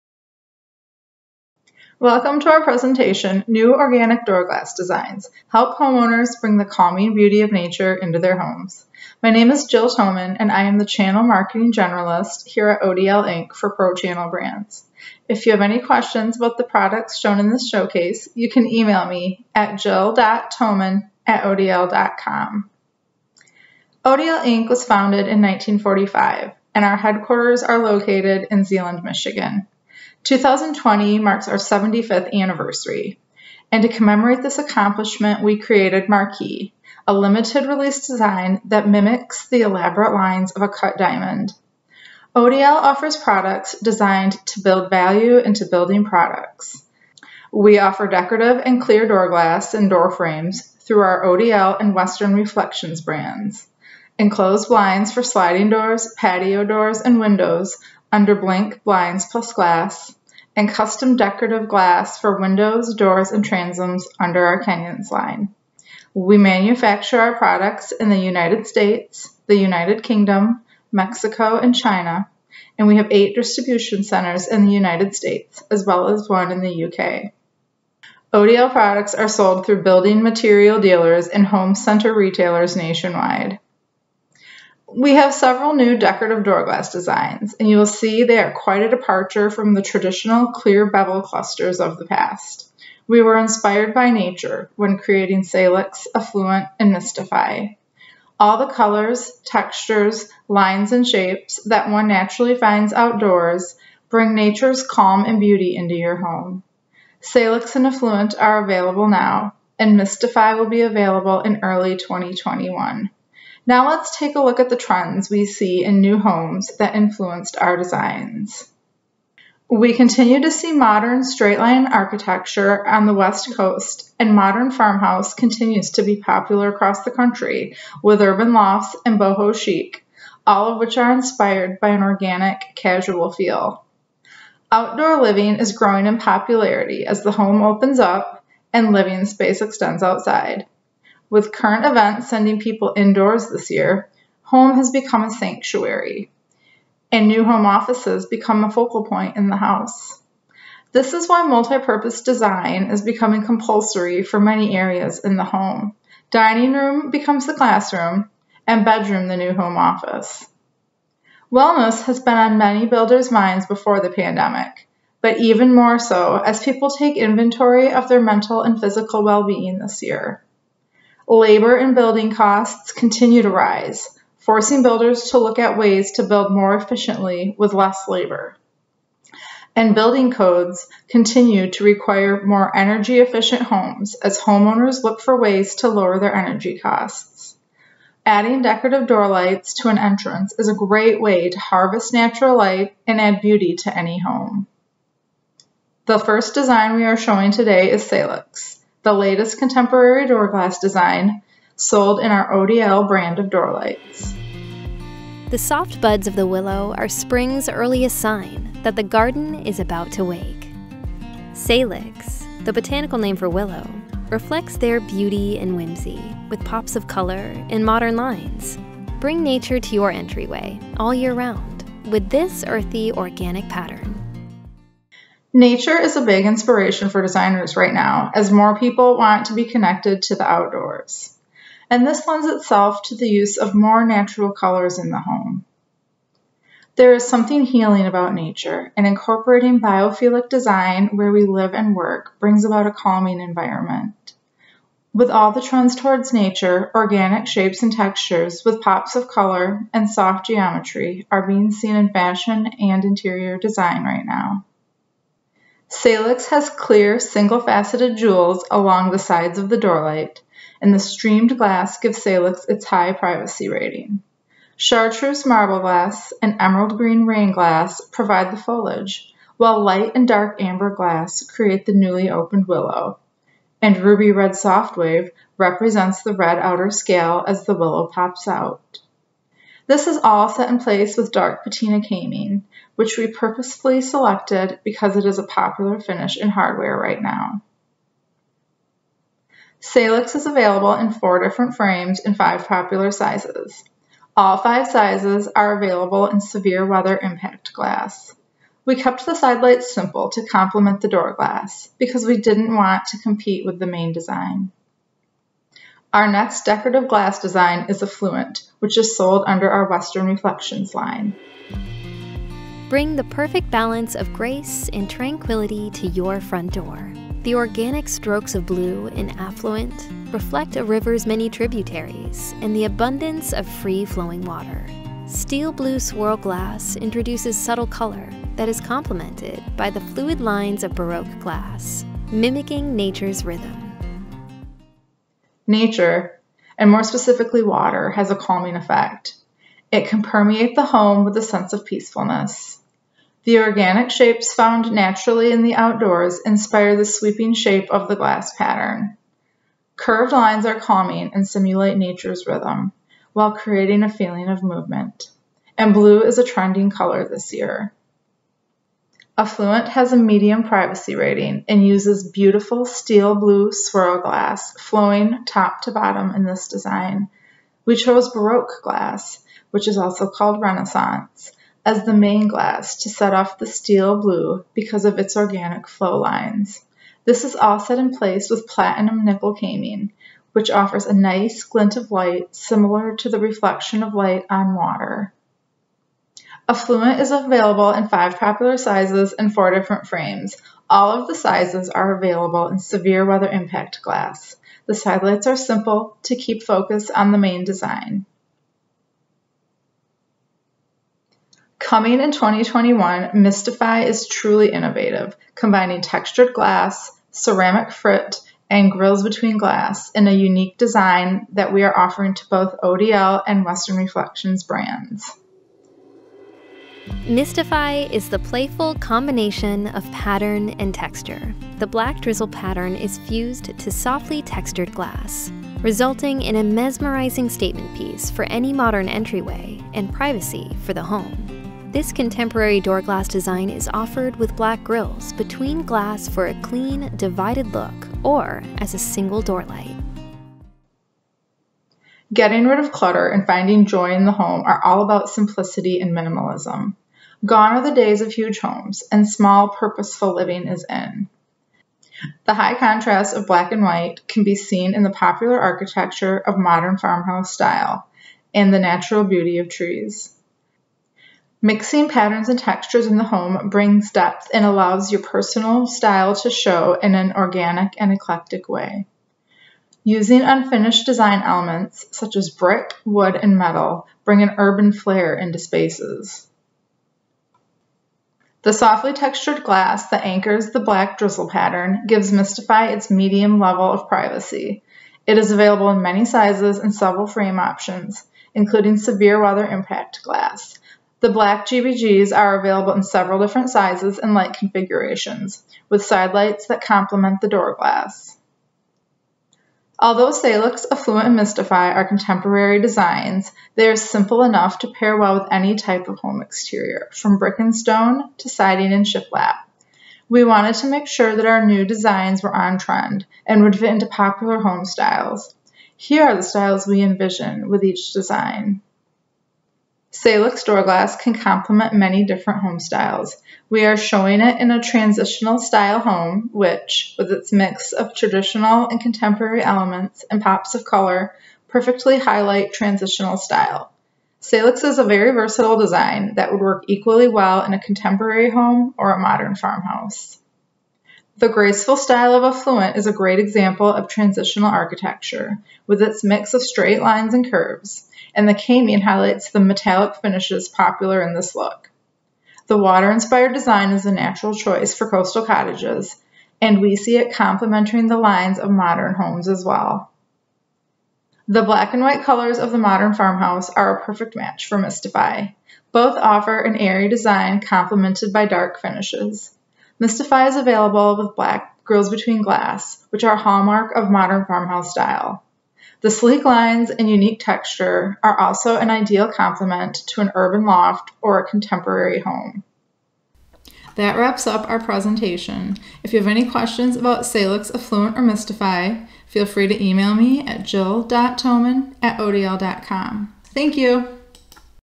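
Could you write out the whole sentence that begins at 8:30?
We wanted to make sure that our new designs were on trend and would fit into popular home styles.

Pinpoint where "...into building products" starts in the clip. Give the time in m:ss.
0:45.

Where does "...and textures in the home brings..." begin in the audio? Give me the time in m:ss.
7:42.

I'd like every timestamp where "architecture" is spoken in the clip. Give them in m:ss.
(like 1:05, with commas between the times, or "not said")
2:01, 7:35, 9:04.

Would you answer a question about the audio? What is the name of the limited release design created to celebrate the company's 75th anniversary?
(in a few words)
Marquee.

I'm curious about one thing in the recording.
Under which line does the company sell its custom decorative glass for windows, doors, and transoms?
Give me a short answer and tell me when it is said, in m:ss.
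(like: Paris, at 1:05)
Kenyon's, at 1:04.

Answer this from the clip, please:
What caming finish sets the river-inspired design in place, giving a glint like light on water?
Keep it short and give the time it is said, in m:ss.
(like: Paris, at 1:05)
Platinum nickel, at 6:18.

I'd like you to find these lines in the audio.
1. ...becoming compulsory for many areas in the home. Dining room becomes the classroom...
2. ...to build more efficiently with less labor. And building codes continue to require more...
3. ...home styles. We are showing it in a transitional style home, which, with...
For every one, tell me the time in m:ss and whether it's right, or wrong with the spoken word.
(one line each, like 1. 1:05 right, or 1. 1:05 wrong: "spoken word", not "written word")
1. 2:33 right
2. 2:56 right
3. 8:42 right.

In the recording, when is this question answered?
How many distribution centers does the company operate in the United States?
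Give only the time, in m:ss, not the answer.
1:13.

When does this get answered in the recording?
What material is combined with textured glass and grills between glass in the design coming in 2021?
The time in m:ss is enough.
6:47.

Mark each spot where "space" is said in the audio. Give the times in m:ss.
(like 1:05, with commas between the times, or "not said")
2:19, 7:55.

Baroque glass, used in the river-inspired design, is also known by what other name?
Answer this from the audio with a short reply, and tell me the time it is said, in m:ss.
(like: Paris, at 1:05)
Renaissance, at 6:10.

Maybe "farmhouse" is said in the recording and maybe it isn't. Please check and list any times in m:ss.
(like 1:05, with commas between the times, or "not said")
2:04, 7:36, 8:59, 9:23, 9:34.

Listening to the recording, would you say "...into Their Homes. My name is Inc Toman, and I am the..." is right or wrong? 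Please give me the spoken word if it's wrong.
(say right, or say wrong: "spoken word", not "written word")
wrong: "Jill", not "Inc".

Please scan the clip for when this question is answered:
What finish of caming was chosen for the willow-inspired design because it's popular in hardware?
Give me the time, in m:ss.
4:41.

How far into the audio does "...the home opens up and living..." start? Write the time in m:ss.
2:17.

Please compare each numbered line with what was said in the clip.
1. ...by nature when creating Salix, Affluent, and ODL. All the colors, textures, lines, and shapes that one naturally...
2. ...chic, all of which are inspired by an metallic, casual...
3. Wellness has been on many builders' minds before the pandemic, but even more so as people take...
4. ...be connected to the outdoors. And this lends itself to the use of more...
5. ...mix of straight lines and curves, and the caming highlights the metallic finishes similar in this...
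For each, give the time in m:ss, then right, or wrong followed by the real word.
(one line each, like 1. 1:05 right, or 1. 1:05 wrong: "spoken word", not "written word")
1. 1:33 wrong: "Mystify", not "ODL"
2. 2:09 wrong: "organic", not "metallic"
3. 2:41 right
4. 3:49 right
5. 9:06 wrong: "popular", not "similar".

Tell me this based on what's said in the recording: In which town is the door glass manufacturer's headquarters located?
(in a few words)
Zeeland, Michigan.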